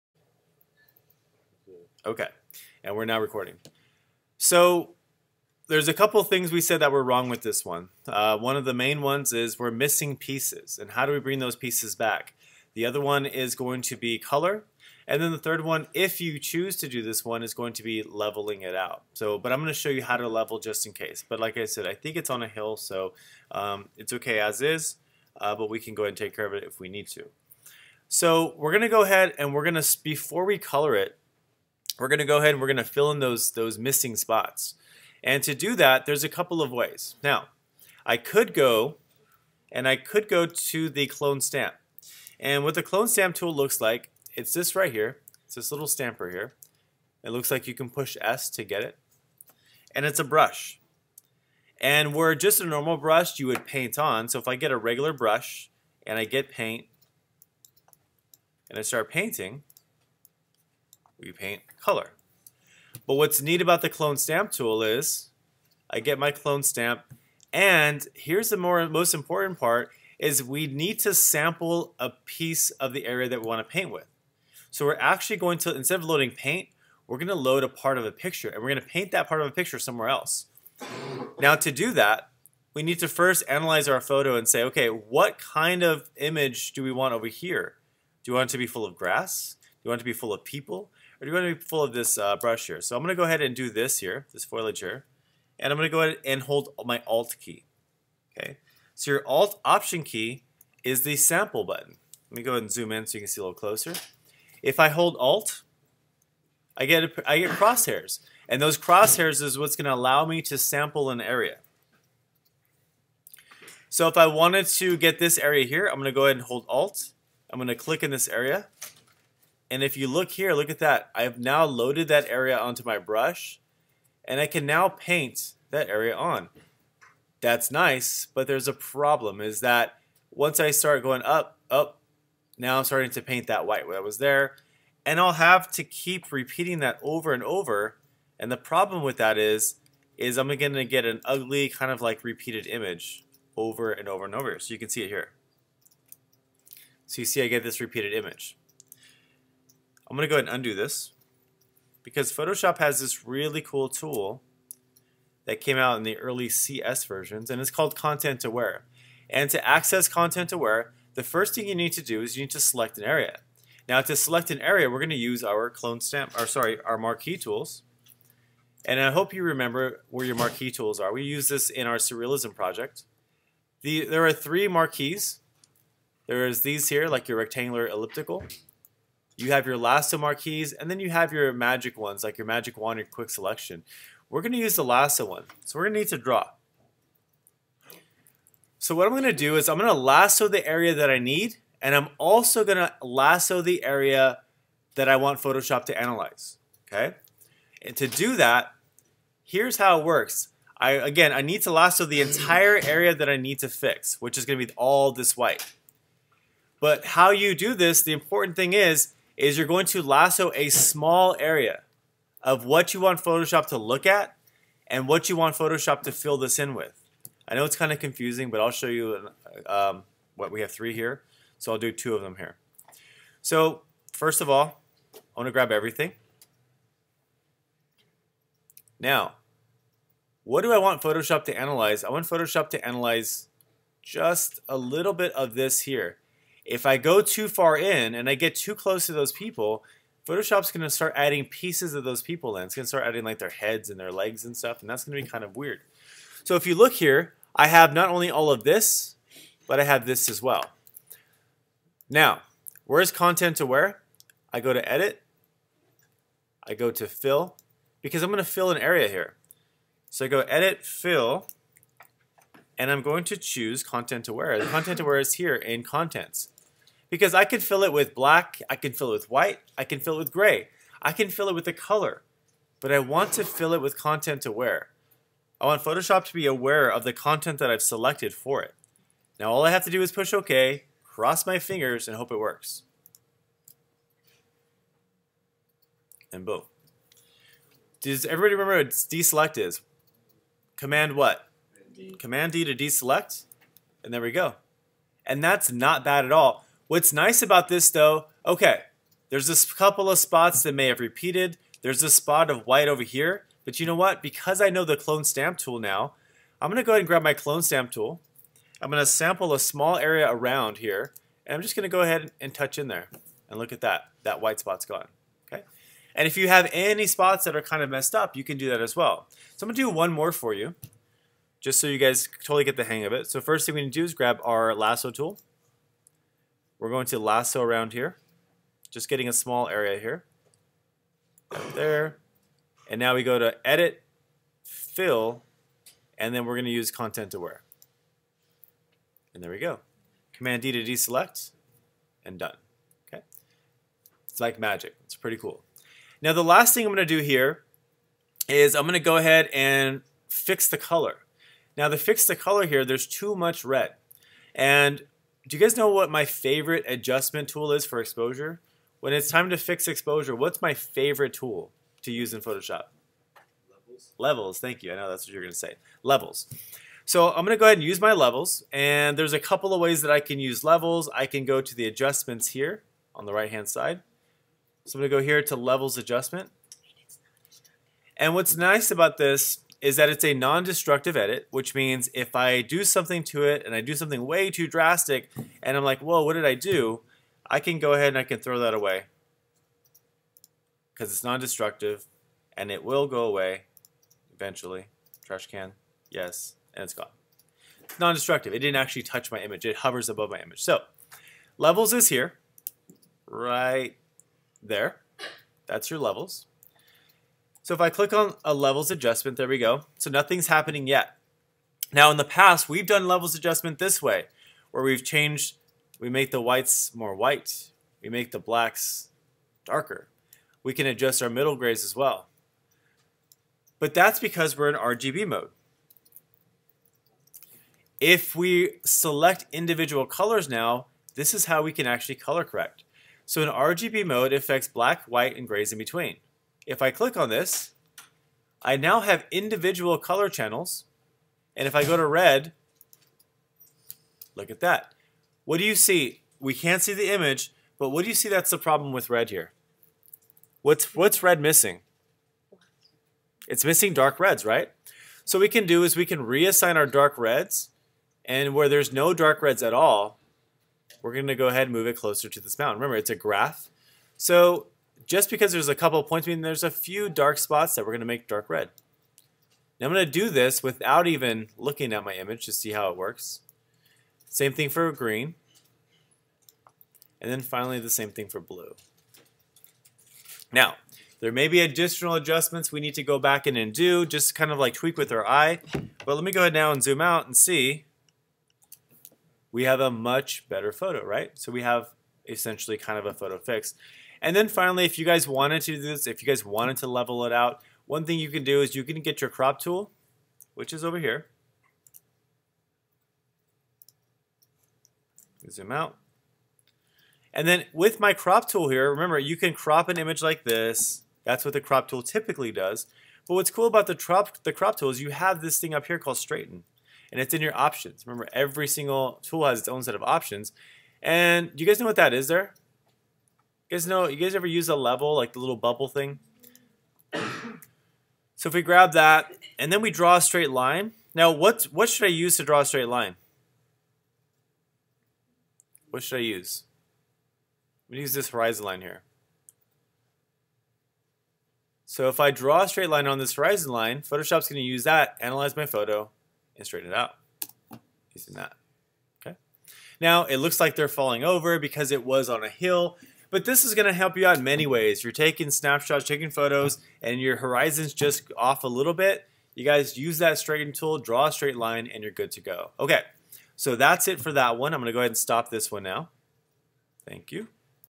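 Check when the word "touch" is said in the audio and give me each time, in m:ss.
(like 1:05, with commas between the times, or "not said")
5:12, 6:39.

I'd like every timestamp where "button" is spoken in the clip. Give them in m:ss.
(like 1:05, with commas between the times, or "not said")
1:41.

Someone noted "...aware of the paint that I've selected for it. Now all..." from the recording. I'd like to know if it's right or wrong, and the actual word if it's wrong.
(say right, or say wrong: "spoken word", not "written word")
wrong: "content", not "paint".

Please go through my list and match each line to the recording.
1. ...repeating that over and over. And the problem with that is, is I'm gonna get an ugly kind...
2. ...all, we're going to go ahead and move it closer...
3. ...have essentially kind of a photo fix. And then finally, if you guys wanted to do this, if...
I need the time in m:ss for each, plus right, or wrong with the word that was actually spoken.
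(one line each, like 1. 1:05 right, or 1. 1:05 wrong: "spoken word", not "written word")
1. 2:16 right
2. 7:39 right
3. 8:11 right.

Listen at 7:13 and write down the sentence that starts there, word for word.
So in RGB mode, it affects black, white, and grays in between.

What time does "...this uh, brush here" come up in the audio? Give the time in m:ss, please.
1:31.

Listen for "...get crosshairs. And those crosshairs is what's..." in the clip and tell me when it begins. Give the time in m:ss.
1:47.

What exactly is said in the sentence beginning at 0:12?
The other one is going to be color.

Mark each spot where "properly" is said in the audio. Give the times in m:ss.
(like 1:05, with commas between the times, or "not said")
not said.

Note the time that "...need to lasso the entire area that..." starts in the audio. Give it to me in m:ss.
3:21.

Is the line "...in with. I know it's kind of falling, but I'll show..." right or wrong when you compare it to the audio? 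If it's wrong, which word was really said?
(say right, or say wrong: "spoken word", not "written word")
wrong: "confusing", not "falling".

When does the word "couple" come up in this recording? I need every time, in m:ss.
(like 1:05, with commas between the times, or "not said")
0:05, 0:36, 4:59, 6:09, 7:45.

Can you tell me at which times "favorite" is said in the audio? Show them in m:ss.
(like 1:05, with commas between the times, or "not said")
5:56, 6:00.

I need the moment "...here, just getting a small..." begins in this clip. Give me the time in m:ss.
5:27.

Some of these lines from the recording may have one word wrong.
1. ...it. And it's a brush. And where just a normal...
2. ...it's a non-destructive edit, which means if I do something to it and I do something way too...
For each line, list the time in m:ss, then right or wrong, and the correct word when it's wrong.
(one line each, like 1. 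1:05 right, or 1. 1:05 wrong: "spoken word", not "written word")
1. 0:48 right
2. 6:20 right.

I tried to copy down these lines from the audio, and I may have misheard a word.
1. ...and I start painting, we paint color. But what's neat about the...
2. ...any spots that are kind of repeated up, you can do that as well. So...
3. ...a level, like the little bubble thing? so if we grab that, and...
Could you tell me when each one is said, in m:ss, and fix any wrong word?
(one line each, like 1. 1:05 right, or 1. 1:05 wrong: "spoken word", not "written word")
1. 0:58 right
2. 5:16 wrong: "messed", not "repeated"
3. 8:44 right.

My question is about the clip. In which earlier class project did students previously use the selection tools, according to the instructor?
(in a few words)
surrealism project.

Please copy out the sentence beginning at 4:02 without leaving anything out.
It's going to start adding like their heads and their legs and stuff, and that's going to be kind of weird.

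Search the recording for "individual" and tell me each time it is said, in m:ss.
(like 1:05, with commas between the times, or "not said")
7:09, 7:19.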